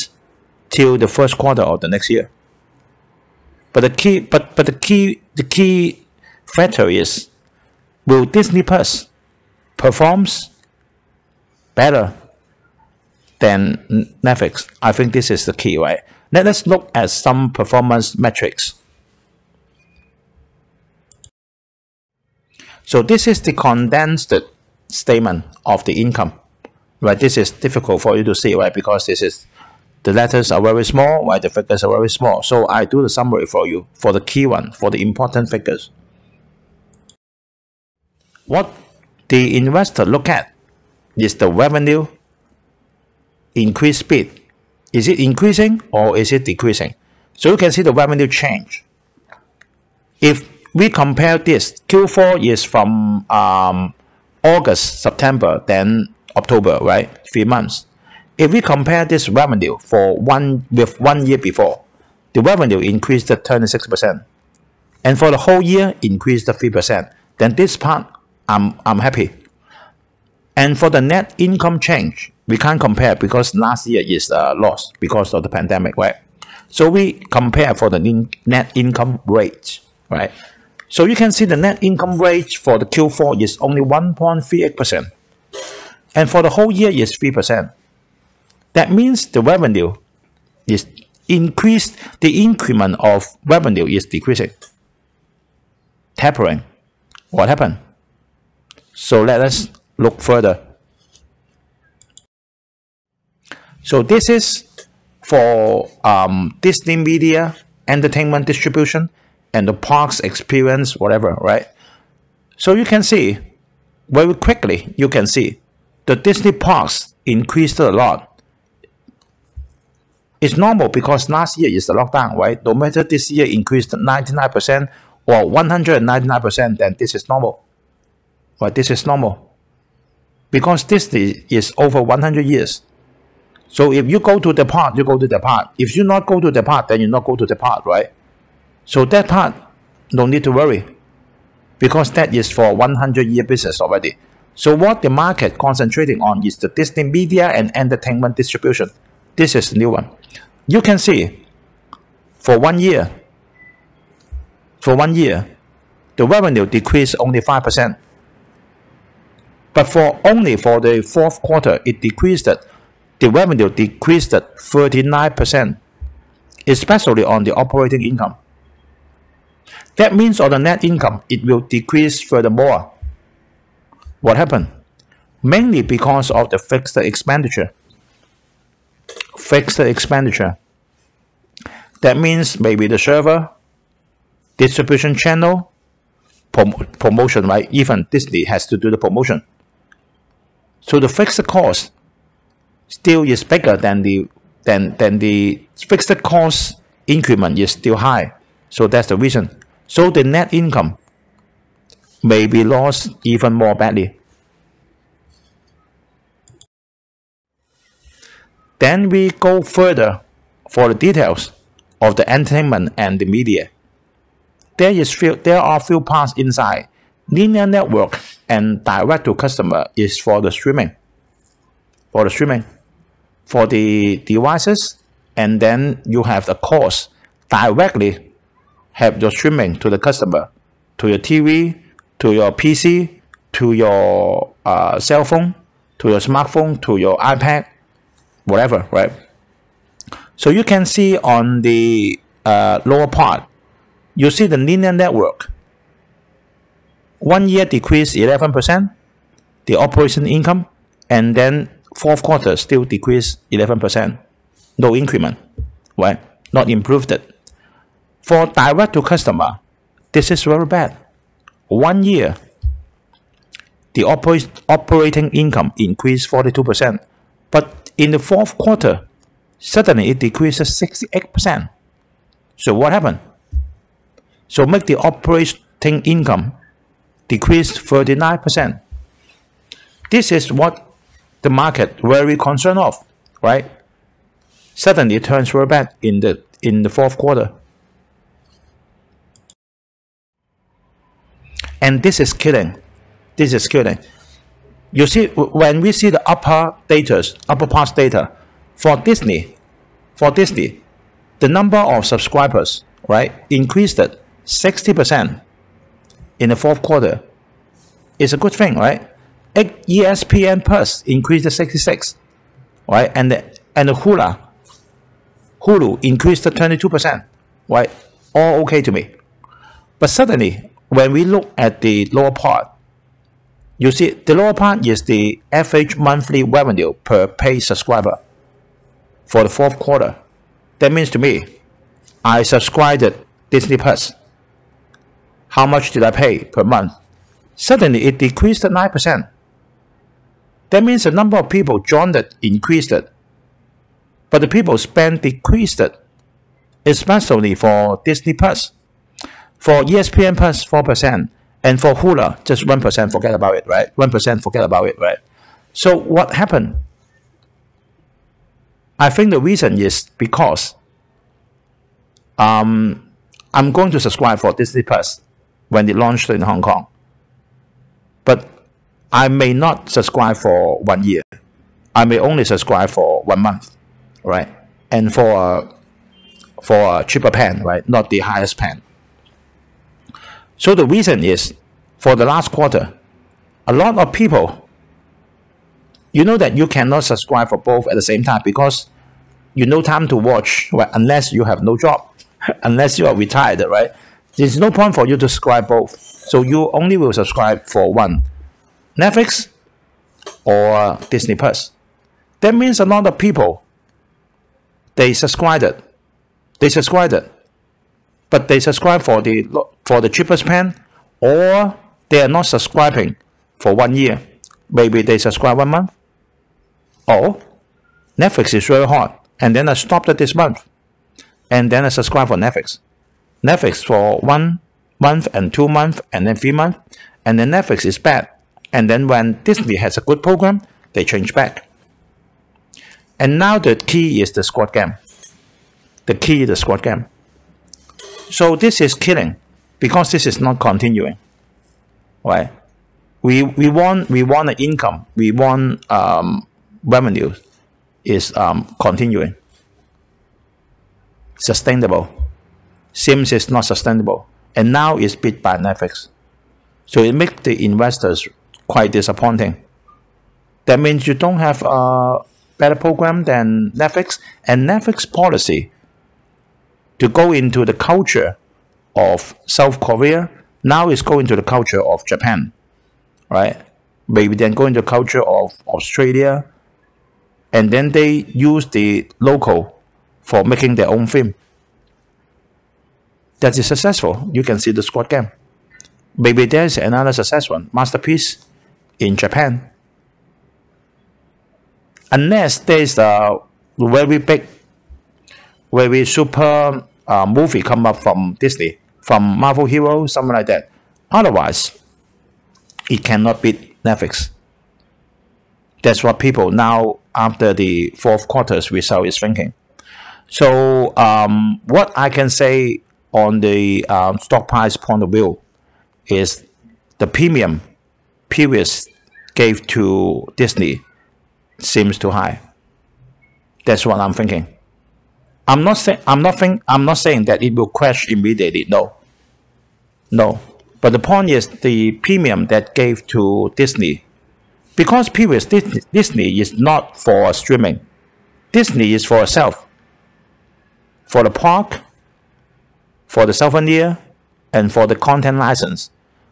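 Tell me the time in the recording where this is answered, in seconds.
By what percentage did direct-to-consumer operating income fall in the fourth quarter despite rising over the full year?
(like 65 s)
270 s.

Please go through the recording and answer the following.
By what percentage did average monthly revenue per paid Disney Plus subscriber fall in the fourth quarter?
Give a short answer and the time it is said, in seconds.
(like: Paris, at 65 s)
9%, at 338 s.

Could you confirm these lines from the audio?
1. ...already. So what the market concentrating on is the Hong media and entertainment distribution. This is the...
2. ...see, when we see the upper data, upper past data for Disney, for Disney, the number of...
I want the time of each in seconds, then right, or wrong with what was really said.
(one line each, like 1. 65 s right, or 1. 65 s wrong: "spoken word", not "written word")
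1. 143 s wrong: "Disney", not "Hong"
2. 295 s right.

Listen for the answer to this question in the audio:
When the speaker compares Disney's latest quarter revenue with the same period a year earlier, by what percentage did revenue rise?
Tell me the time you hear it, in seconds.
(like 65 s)
63 s.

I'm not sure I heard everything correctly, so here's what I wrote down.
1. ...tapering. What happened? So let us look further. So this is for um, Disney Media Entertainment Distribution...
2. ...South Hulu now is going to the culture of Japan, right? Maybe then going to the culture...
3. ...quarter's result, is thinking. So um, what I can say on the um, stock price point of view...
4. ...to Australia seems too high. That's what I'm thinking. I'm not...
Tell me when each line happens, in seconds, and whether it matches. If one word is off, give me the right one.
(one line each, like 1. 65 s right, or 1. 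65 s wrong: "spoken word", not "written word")
1. 96 s right
2. 469 s wrong: "Korea", not "Hulu"
3. 508 s right
4. 519 s wrong: "Disney", not "Australia".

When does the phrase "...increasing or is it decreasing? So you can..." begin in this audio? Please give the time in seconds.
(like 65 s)
45 s.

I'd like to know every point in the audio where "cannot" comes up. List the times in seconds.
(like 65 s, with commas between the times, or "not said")
386 s, 503 s.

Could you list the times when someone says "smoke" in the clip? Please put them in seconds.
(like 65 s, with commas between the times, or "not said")
not said.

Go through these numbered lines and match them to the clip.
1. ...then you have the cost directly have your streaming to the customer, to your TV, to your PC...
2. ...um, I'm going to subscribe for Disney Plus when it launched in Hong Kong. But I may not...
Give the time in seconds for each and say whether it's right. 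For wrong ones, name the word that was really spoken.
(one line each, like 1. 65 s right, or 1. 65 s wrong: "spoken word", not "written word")
1. 225 s right
2. 362 s right.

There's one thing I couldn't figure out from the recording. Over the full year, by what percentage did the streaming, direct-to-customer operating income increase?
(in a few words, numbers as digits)
42%.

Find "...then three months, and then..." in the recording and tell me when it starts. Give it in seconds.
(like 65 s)
426 s.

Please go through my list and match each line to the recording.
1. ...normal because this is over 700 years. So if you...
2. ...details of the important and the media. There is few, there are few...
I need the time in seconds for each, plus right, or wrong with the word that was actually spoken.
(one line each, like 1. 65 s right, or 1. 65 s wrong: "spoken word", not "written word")
1. 129 s wrong: "100", not "700"
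2. 210 s wrong: "entertainment", not "important".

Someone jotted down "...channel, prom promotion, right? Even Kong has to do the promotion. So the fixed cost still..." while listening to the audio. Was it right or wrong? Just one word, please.
wrong.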